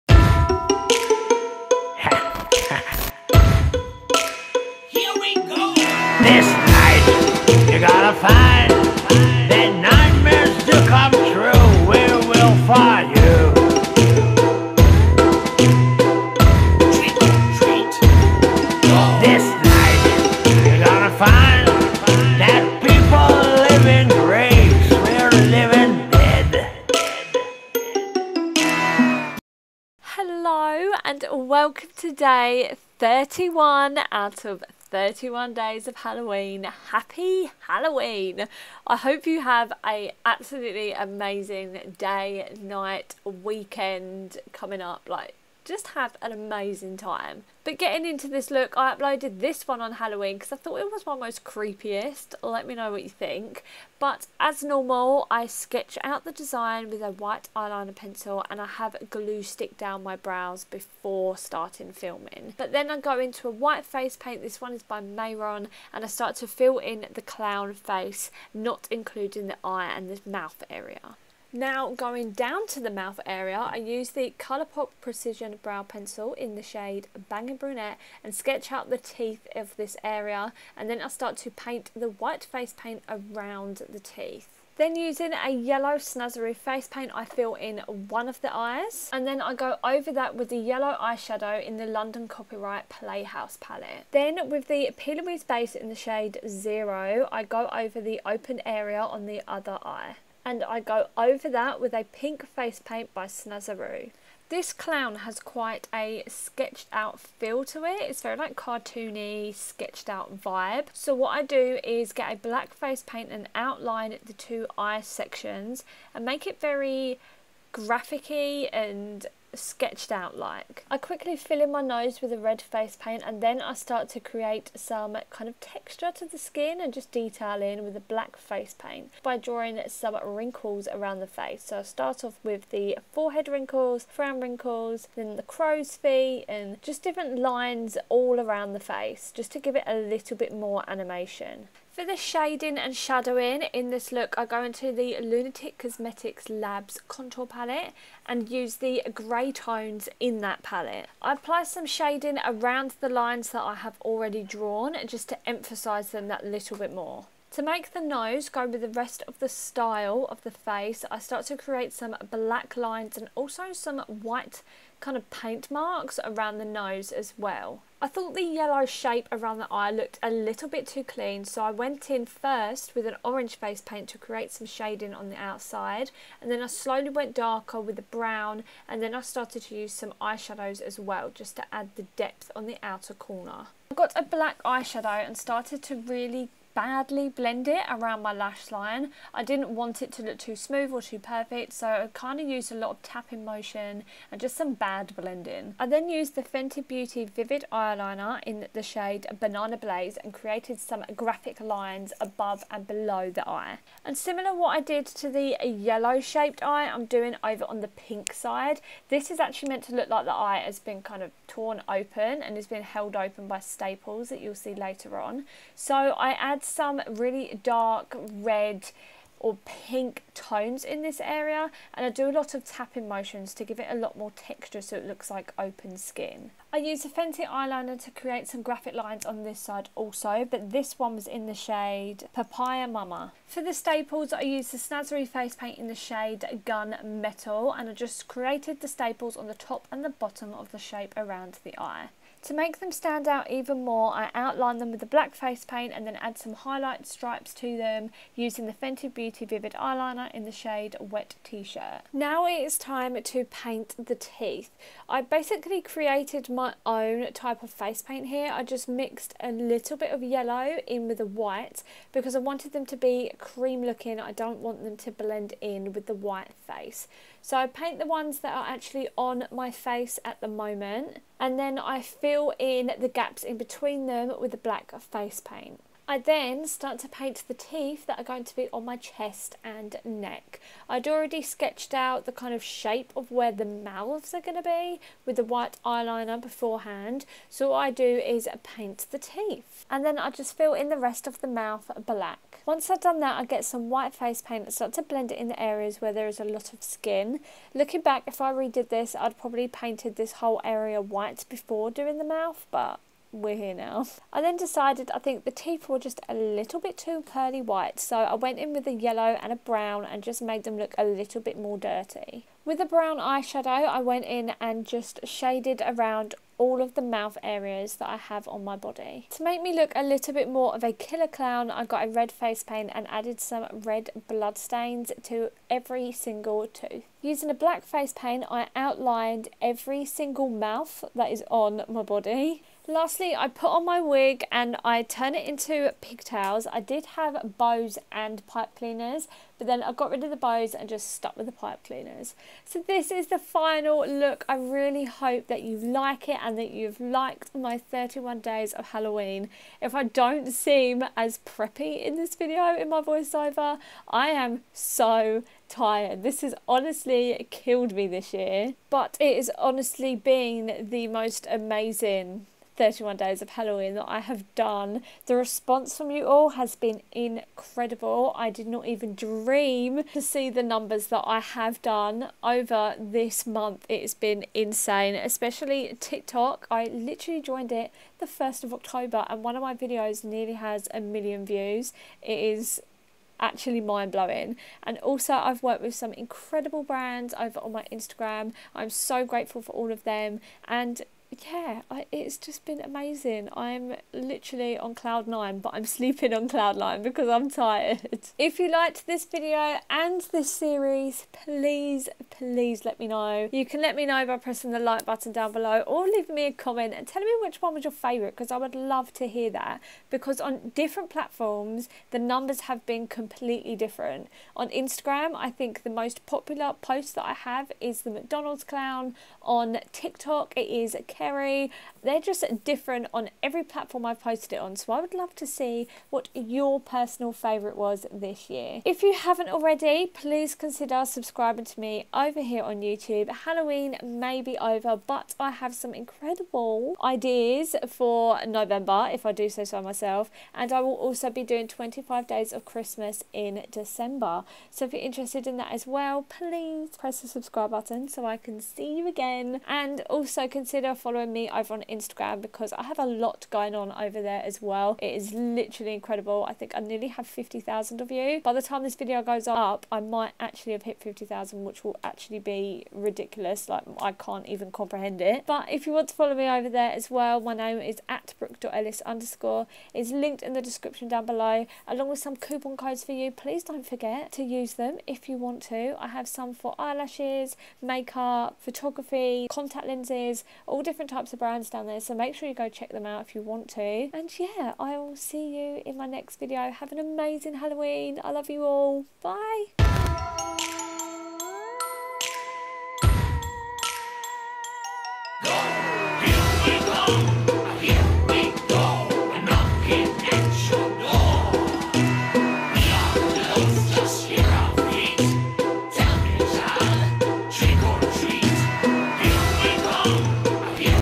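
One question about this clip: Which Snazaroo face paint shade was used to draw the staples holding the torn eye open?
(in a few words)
Gun Metal.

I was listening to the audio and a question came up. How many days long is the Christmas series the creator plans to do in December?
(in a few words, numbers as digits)
25.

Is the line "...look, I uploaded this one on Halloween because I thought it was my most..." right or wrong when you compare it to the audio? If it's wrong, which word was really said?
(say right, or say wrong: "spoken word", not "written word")
right.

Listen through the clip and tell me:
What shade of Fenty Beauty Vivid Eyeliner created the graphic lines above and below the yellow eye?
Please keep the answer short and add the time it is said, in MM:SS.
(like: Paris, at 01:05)
Banana Blaze, at 03:19.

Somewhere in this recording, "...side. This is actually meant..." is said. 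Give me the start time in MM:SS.
03:28.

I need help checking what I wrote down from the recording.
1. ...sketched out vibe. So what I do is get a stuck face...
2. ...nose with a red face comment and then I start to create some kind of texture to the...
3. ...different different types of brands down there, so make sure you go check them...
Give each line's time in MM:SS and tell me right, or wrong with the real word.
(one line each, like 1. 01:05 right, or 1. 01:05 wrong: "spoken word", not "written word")
1. 01:49 wrong: "black", not "stuck"
2. 02:01 wrong: "paint", not "comment"
3. 08:00 right.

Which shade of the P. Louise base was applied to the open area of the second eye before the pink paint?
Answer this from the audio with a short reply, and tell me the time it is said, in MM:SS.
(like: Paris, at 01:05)
Zero, at 01:36.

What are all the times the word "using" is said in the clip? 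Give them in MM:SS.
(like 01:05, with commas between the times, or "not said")
01:24, 04:08, 05:27.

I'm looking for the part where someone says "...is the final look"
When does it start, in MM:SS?
05:43.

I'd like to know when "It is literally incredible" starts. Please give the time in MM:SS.
07:35.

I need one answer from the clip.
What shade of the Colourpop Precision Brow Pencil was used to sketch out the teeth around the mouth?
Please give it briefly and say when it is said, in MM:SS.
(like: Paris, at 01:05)
Bangin' Brunette, at 01:17.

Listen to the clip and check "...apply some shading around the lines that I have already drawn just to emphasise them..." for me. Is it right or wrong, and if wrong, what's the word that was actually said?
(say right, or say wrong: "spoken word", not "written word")
right.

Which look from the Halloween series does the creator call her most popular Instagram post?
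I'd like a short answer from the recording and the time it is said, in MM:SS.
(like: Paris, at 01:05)
McDonald's clown, at 06:58.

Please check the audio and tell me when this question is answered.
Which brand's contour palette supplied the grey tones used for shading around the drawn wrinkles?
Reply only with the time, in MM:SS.
02:25.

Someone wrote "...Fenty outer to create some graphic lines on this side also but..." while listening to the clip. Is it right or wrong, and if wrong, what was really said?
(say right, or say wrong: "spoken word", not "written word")
wrong: "eyeliner", not "outer".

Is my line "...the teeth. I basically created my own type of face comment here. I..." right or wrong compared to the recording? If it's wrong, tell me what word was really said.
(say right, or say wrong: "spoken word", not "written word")
wrong: "paint", not "comment".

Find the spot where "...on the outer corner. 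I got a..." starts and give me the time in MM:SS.
03:02.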